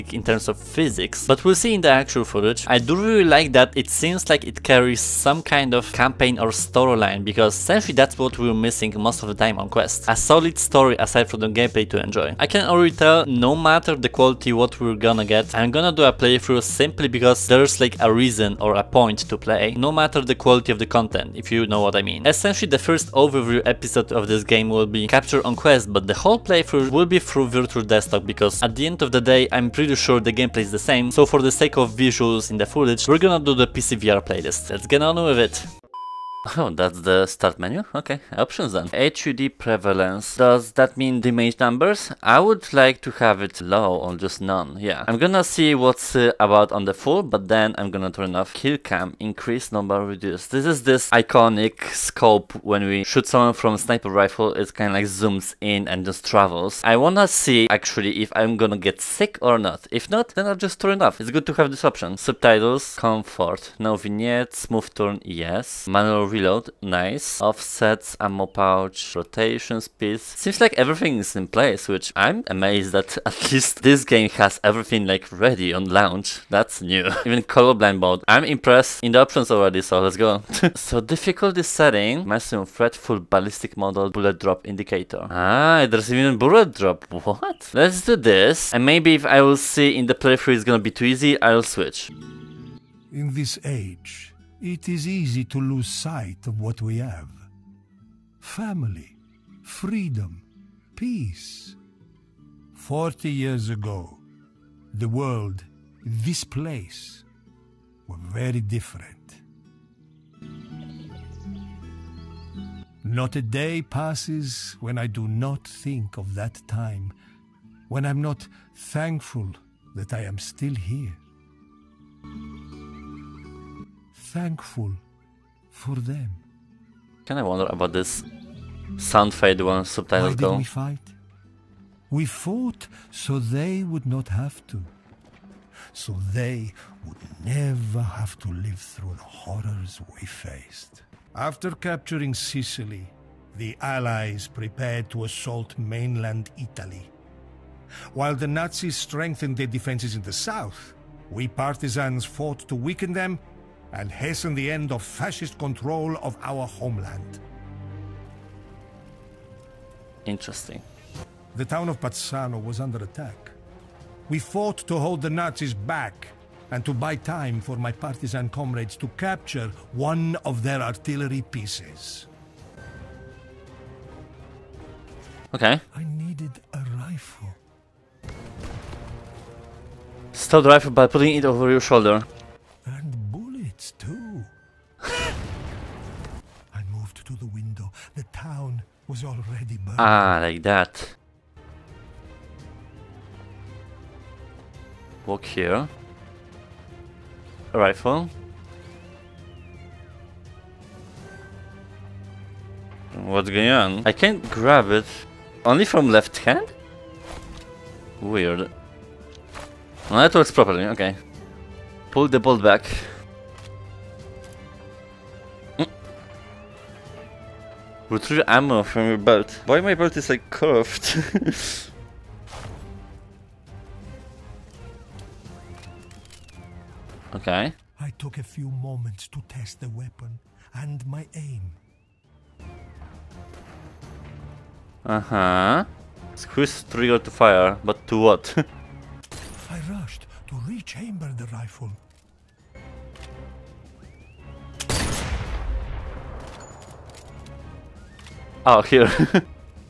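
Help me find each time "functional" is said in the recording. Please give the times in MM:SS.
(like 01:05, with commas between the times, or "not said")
not said.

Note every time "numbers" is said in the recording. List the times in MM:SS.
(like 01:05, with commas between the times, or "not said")
00:41, 00:49.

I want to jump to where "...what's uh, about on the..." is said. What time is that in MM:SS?
00:45.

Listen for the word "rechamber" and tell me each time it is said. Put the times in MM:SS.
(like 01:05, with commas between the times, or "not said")
04:00.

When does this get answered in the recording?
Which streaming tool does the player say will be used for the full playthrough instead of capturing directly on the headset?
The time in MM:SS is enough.
00:27.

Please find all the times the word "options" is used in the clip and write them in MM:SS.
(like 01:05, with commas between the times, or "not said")
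00:38, 01:01, 01:19.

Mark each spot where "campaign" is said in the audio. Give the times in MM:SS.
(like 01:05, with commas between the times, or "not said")
00:05.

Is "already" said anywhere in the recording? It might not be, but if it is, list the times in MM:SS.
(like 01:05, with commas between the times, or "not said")
00:12, 01:19.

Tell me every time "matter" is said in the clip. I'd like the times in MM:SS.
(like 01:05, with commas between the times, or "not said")
00:13, 00:19.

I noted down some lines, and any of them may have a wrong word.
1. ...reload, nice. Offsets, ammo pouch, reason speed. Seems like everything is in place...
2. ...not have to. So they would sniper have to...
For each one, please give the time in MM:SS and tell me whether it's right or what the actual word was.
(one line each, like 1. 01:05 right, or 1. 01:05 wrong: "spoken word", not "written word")
1. 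01:06 wrong: "rotation", not "reason"
2. 02:14 wrong: "never", not "sniper".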